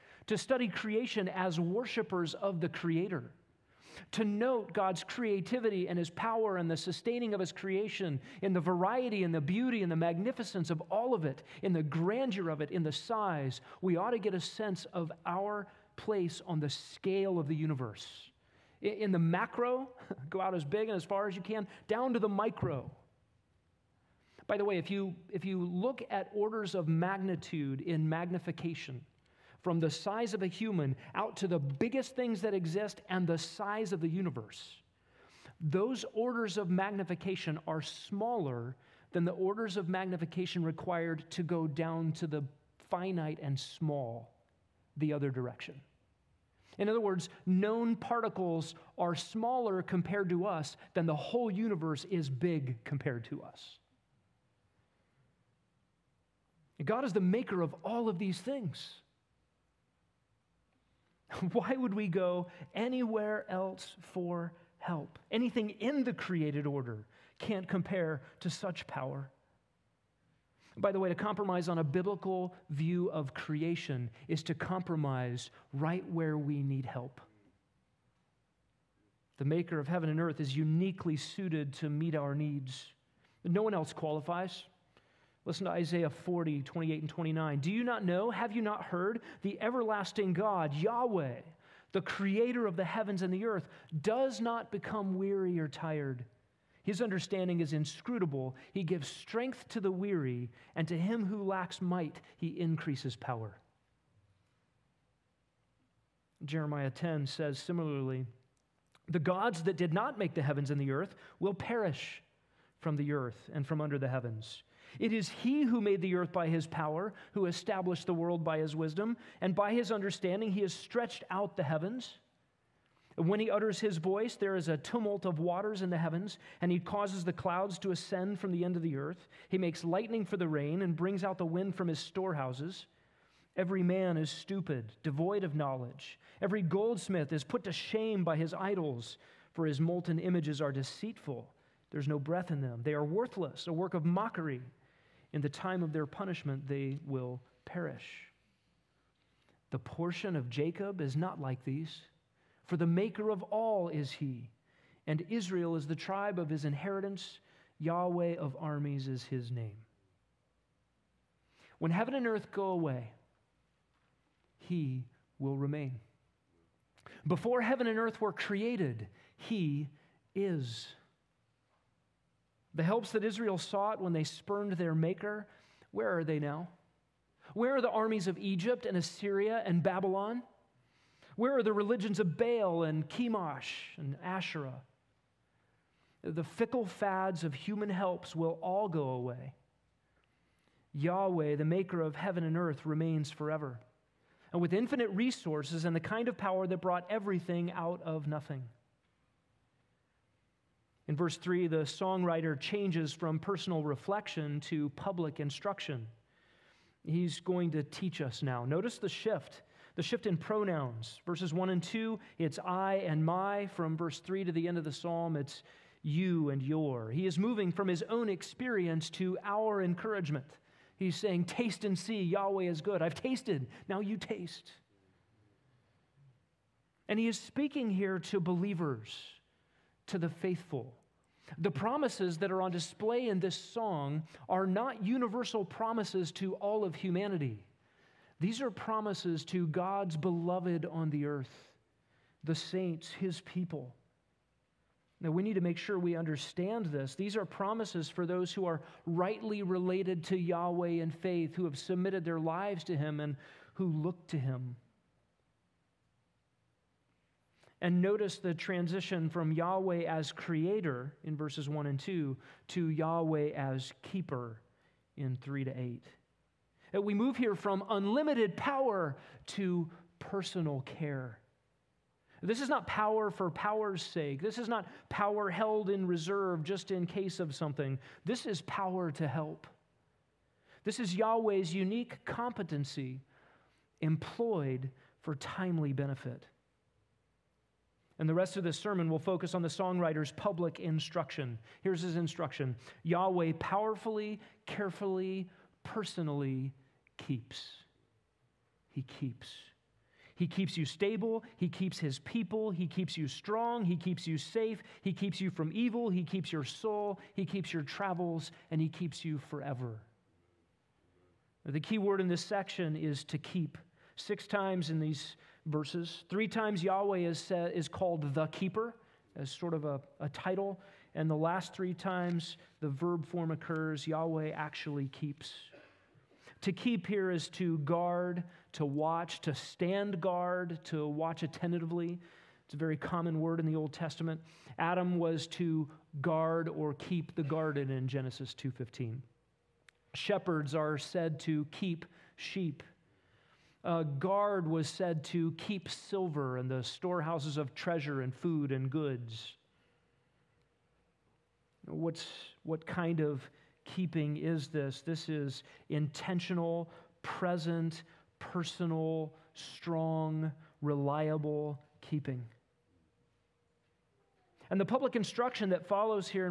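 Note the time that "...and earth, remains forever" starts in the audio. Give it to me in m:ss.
3:12.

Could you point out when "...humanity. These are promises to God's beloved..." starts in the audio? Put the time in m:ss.
3:56.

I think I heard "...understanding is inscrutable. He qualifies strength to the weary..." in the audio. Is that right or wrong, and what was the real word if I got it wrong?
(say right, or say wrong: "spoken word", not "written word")
wrong: "gives", not "qualifies".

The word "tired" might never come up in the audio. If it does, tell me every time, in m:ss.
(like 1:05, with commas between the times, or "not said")
1:35.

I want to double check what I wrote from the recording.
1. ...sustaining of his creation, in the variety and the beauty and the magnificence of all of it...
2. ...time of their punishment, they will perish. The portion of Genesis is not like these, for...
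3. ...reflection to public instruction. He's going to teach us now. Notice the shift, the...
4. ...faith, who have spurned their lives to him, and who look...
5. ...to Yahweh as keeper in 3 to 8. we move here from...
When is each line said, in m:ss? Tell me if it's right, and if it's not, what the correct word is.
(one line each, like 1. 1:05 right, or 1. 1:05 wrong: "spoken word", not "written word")
1. 0:06 right
2. 2:25 wrong: "Jacob", not "Genesis"
3. 3:23 right
4. 4:11 wrong: "submitted", not "spurned"
5. 4:22 right.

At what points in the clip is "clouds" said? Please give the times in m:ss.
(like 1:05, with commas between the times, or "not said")
2:07.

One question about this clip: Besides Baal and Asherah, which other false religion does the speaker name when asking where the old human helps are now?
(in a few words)
Chemosh.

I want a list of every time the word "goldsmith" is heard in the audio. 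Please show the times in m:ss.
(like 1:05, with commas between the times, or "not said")
2:16.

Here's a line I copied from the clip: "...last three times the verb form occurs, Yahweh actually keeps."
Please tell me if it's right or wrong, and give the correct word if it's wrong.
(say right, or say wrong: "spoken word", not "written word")
right.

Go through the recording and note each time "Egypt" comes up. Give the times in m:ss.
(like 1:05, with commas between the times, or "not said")
2:58.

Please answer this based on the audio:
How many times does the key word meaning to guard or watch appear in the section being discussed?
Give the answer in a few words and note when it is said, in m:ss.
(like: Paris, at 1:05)
6, at 5:14.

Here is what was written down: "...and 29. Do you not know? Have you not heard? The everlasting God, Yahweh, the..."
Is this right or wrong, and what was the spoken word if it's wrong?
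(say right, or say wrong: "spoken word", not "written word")
right.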